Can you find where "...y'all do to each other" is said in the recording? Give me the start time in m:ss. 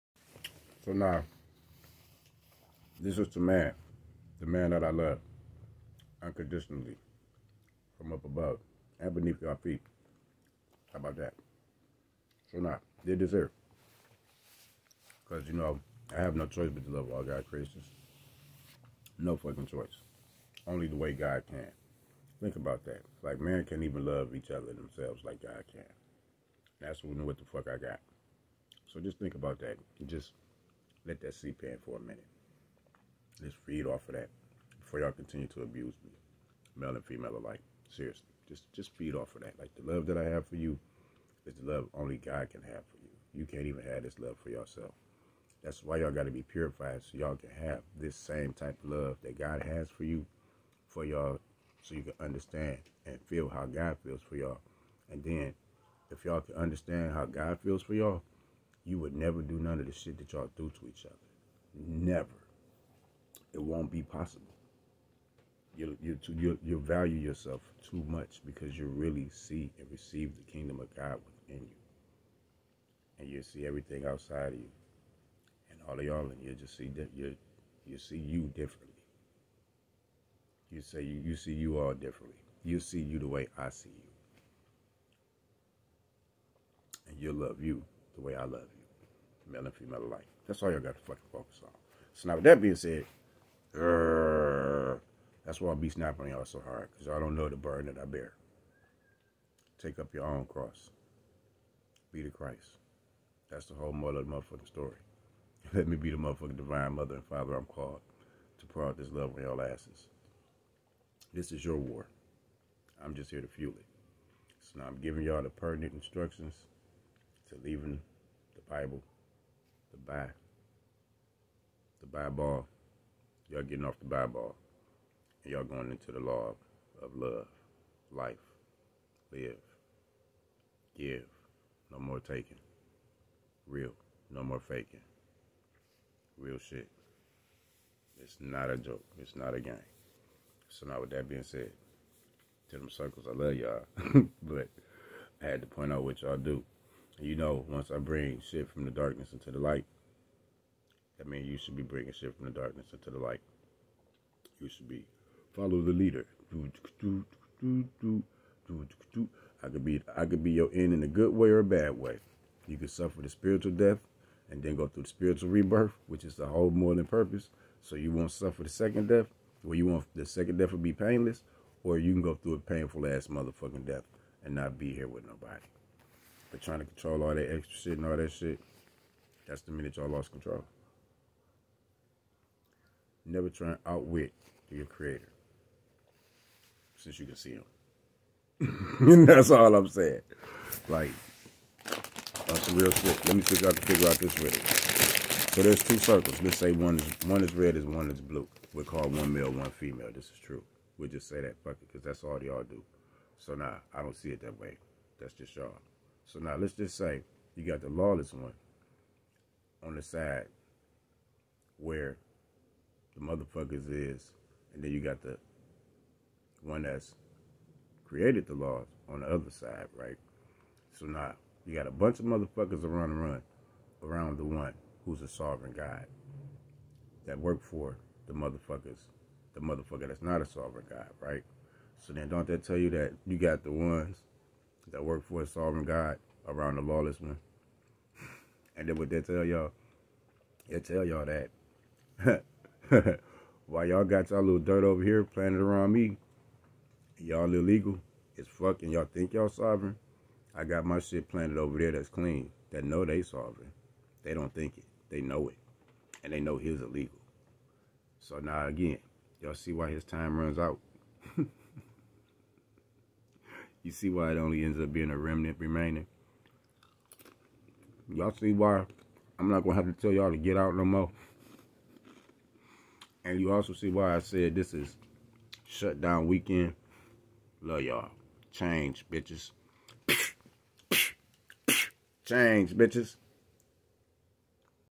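1:00.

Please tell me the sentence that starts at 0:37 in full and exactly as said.
Seriously, just just feed off of that.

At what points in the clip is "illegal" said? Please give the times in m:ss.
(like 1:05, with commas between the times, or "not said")
4:07, 4:16.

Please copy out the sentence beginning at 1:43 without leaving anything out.
That's the whole of the motherfucking story.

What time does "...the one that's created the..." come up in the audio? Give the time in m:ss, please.
3:35.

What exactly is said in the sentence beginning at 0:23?
Like, man can't even love each other themselves like God can.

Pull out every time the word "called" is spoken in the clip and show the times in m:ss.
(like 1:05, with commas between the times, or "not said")
1:47, 3:18.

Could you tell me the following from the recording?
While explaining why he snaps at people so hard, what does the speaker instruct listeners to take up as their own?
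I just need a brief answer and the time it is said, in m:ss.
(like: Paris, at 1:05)
Your own cross, at 1:40.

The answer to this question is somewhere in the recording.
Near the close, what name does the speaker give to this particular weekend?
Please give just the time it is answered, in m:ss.
4:35.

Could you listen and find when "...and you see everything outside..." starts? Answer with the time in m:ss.
1:13.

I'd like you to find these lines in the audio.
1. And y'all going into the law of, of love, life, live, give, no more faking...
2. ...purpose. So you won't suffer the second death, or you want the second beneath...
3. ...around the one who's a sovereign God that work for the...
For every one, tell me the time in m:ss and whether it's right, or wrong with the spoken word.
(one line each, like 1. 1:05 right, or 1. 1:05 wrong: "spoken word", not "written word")
1. 2:05 wrong: "taking", not "faking"
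2. 2:47 wrong: "death", not "beneath"
3. 3:44 right.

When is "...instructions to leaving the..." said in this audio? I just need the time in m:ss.
1:55.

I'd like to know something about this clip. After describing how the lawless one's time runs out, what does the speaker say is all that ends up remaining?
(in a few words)
A remnant.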